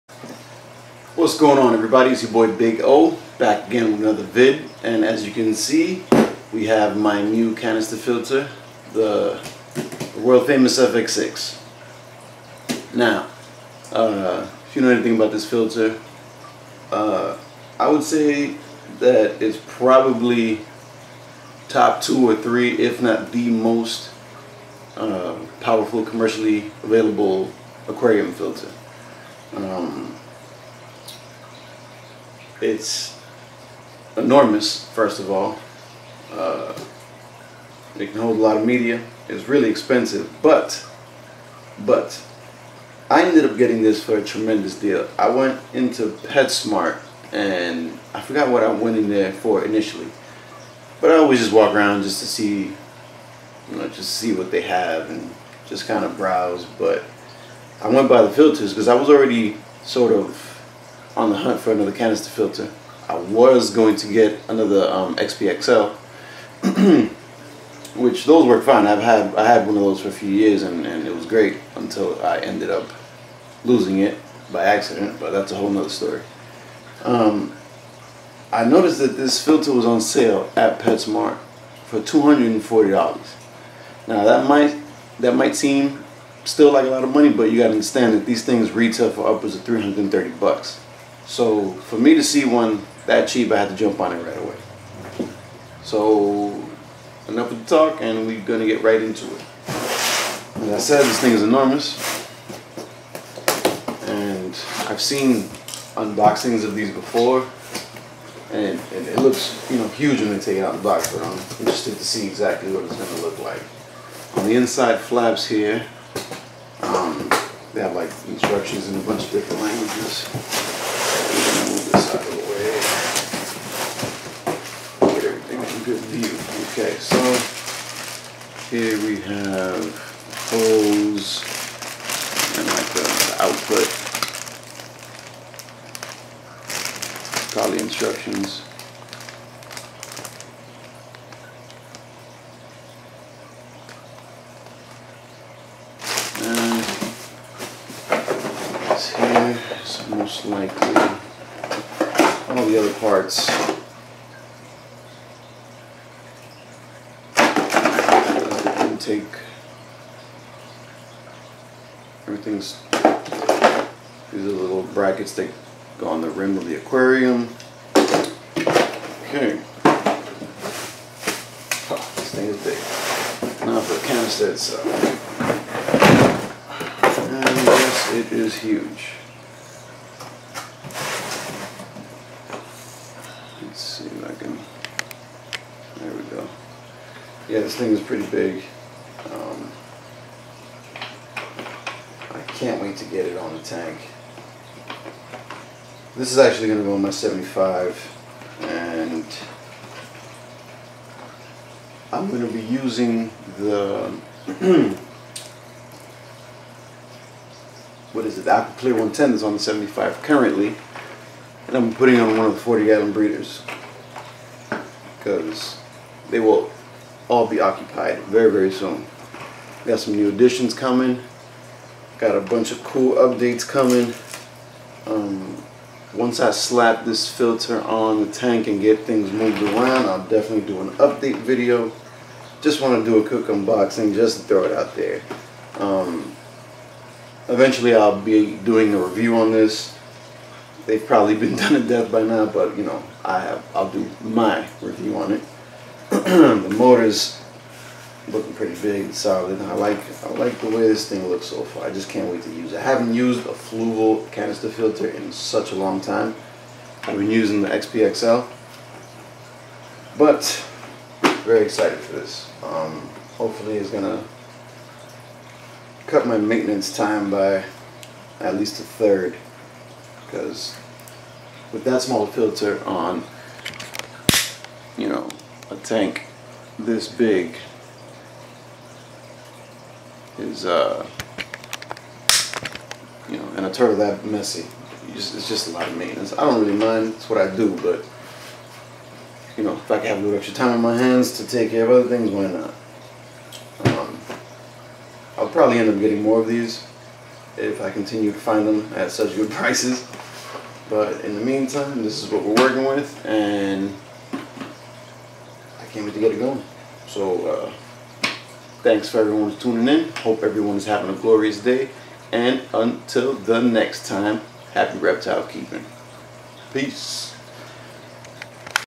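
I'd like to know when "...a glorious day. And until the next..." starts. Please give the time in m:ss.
5:11.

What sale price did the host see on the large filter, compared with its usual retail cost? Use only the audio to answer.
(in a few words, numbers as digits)
$240.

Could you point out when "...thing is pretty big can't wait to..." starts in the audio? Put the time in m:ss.
3:07.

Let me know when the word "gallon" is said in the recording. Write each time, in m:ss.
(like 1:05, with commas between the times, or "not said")
3:32.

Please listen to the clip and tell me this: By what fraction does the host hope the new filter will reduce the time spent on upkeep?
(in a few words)
a third.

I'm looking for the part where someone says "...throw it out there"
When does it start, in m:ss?
3:54.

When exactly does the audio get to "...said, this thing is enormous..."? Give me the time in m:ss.
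1:40.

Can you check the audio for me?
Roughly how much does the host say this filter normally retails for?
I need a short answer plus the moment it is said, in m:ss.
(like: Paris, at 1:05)
$330, at 1:29.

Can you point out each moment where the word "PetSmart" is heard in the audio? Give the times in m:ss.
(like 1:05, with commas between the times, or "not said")
0:46, 1:20.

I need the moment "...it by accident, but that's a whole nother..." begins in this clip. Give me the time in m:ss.
1:13.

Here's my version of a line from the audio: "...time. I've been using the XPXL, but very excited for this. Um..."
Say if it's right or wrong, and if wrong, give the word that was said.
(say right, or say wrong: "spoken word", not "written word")
right.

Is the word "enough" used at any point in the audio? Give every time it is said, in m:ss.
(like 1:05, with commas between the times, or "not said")
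1:37.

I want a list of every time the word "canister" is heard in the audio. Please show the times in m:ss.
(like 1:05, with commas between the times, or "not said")
0:07, 1:01, 2:54, 4:14.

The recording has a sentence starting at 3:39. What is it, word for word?
We got some new additions coming Got a bunch of cool updates coming.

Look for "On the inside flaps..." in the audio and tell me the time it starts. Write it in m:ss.
1:54.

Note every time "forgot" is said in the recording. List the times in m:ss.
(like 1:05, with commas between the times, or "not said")
0:48.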